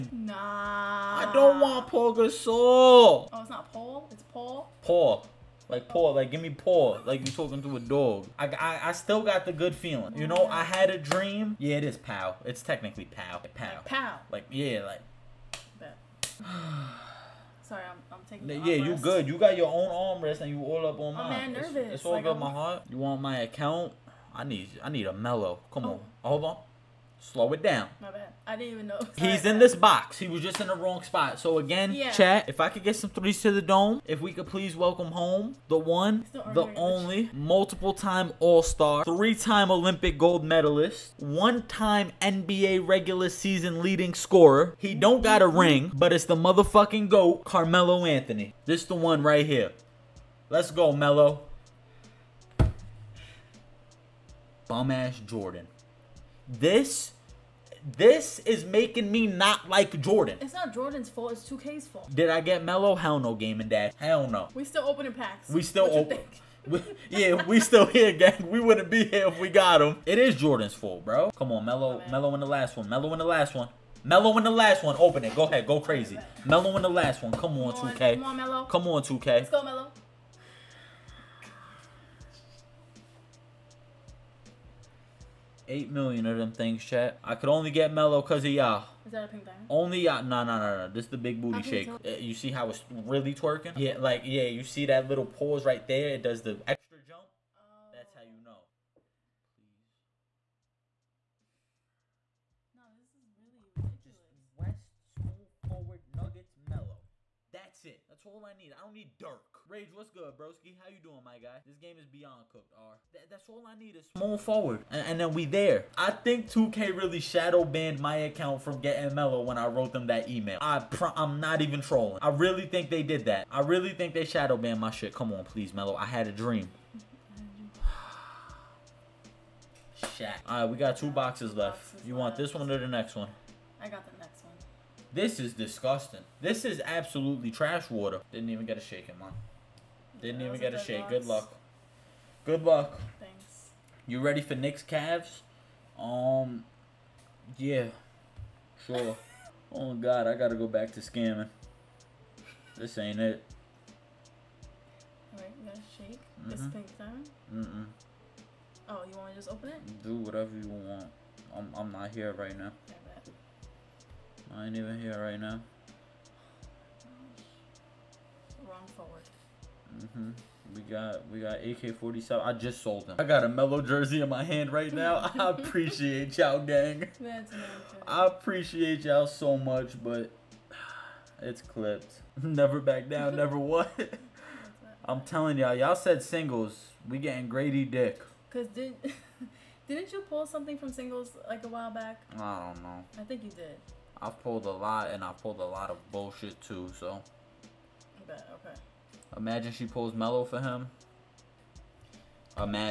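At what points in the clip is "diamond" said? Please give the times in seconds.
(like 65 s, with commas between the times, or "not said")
89 s, 156 s.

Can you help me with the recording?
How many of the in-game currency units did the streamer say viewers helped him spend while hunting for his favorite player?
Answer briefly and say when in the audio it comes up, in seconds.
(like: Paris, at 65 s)
8 million, at 85 s.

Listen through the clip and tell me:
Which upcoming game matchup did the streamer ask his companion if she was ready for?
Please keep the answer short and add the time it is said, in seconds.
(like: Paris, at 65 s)
Knicks Cavs, at 144 s.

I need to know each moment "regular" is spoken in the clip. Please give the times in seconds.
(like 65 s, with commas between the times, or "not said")
42 s.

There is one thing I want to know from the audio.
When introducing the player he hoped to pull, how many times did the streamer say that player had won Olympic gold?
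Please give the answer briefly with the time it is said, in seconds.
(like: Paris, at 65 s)
3, at 39 s.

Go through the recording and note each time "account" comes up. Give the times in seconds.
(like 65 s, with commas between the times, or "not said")
23 s, 118 s.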